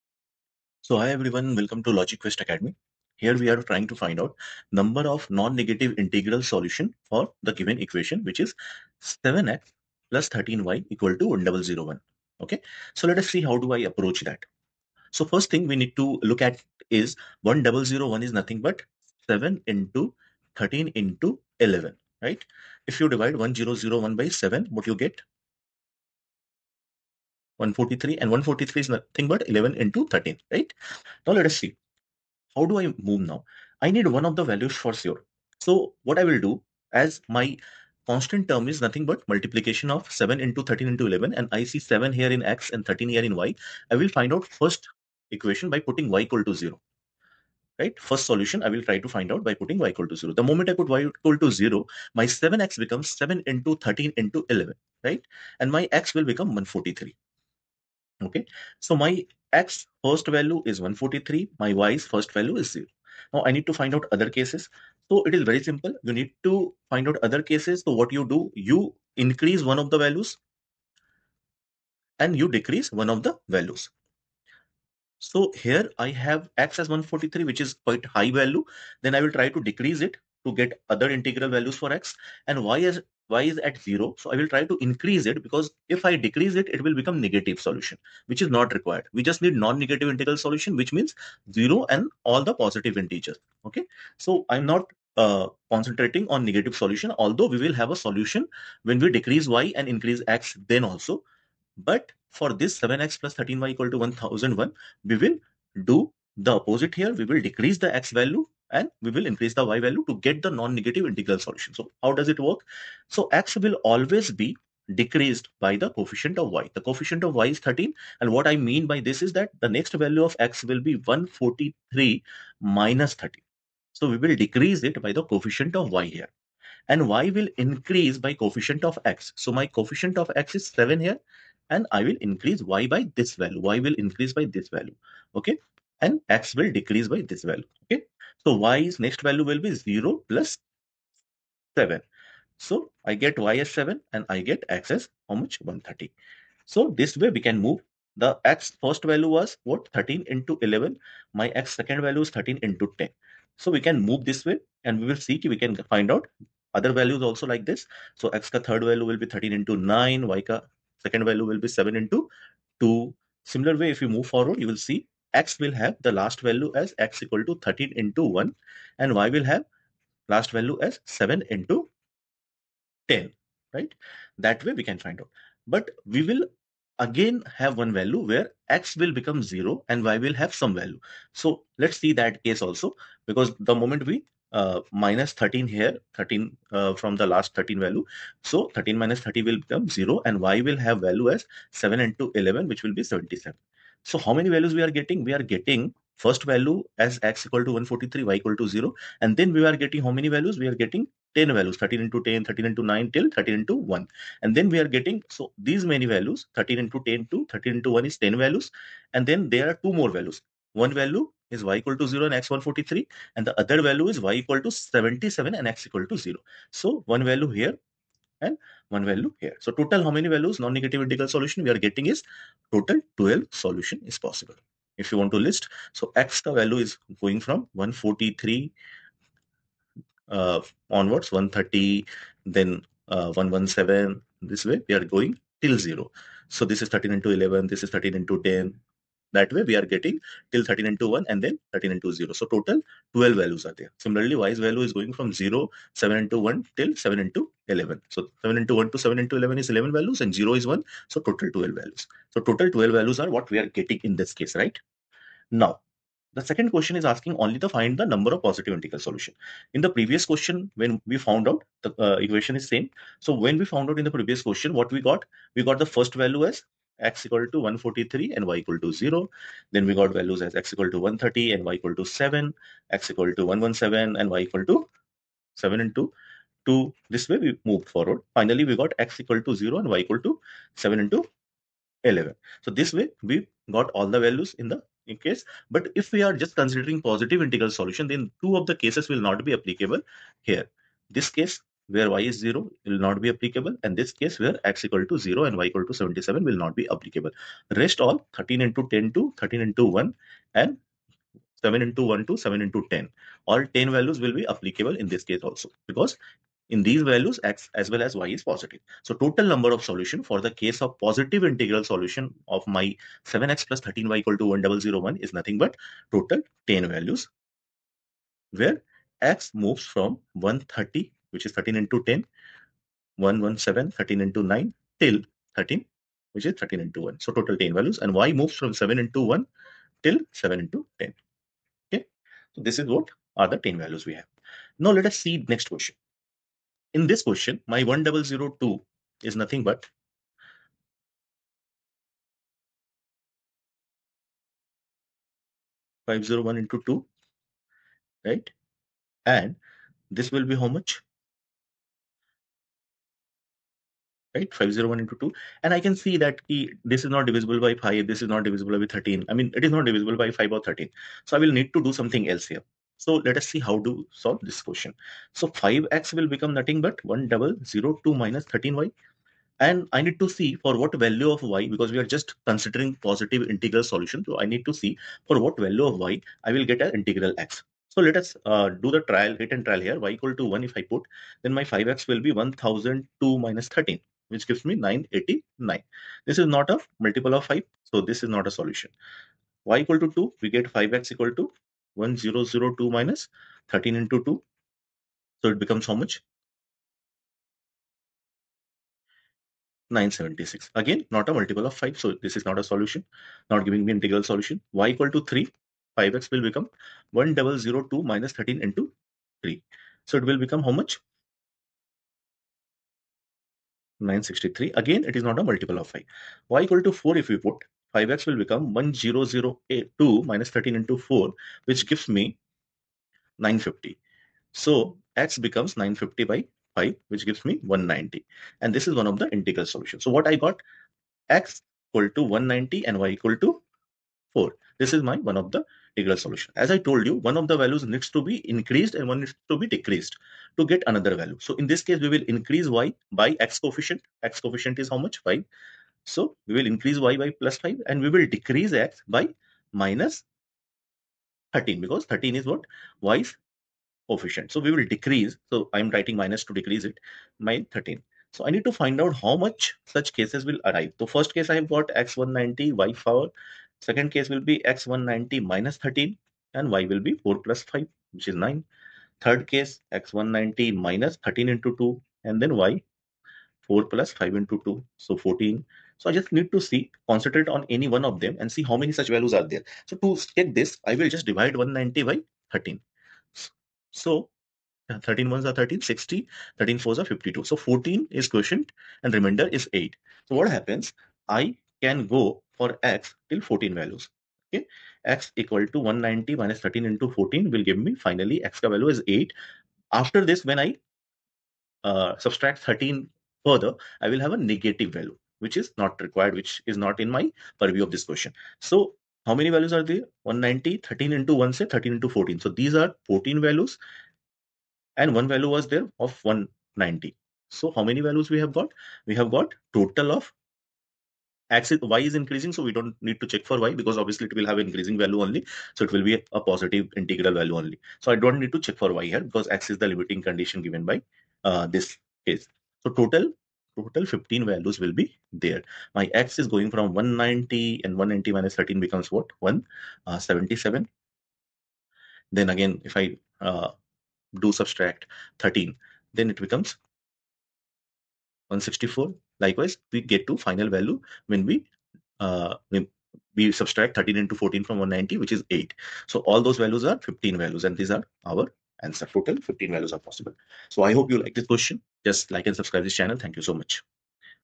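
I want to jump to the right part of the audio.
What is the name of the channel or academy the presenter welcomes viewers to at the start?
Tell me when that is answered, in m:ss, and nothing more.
0:01.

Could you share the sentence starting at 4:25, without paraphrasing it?
We got the first value as x equal to 143 and y equal to 0.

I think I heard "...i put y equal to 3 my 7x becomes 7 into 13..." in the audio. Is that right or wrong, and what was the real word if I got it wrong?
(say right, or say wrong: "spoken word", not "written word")
wrong: "0", not "3".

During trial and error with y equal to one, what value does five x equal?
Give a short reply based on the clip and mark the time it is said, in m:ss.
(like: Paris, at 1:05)
989, at 6:24.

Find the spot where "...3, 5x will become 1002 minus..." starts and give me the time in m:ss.
6:45.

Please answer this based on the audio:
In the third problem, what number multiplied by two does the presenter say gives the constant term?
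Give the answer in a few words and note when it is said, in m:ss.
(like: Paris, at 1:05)
501, at 5:54.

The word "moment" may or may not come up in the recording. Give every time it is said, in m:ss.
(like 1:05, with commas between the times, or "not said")
0:50, 3:03.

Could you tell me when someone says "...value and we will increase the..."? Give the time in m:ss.
1:48.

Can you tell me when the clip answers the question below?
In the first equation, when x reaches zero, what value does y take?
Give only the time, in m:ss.
3:12.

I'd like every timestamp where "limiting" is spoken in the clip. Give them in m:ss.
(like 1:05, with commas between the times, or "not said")
8:49.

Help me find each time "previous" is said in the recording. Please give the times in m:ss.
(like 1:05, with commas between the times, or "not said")
4:19, 4:24.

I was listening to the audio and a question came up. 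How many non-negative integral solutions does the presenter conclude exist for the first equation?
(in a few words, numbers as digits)
12.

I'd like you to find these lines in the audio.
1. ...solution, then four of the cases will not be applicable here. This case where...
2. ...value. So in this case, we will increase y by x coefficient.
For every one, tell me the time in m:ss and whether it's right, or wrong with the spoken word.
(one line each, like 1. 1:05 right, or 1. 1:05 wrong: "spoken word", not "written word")
1. 4:47 wrong: "two", not "four"
2. 7:21 right.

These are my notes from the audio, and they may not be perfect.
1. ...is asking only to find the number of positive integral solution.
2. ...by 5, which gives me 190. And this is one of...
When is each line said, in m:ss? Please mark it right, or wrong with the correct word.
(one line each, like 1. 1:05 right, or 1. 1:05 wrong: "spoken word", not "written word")
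1. 4:16 right
2. 7:06 right.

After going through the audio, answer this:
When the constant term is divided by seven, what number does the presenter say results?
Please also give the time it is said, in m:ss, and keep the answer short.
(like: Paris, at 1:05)
143, at 0:27.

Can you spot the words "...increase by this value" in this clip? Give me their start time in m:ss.
2:13.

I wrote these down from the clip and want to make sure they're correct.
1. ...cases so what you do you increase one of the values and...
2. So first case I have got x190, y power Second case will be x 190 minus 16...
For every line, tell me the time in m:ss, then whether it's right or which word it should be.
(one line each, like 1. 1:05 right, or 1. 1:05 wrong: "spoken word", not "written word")
1. 1:07 right
2. 7:40 wrong: "13", not "16".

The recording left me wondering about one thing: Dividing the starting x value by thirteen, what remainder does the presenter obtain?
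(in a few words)
8.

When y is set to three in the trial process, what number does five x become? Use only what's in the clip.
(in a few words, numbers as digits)
963.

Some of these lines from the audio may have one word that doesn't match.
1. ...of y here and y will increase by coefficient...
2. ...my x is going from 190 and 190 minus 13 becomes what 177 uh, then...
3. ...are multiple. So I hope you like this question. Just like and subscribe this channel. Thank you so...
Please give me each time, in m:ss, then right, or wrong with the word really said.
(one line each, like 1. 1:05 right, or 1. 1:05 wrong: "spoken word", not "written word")
1. 2:05 right
2. 8:55 right
3. 9:19 wrong: "possible", not "multiple".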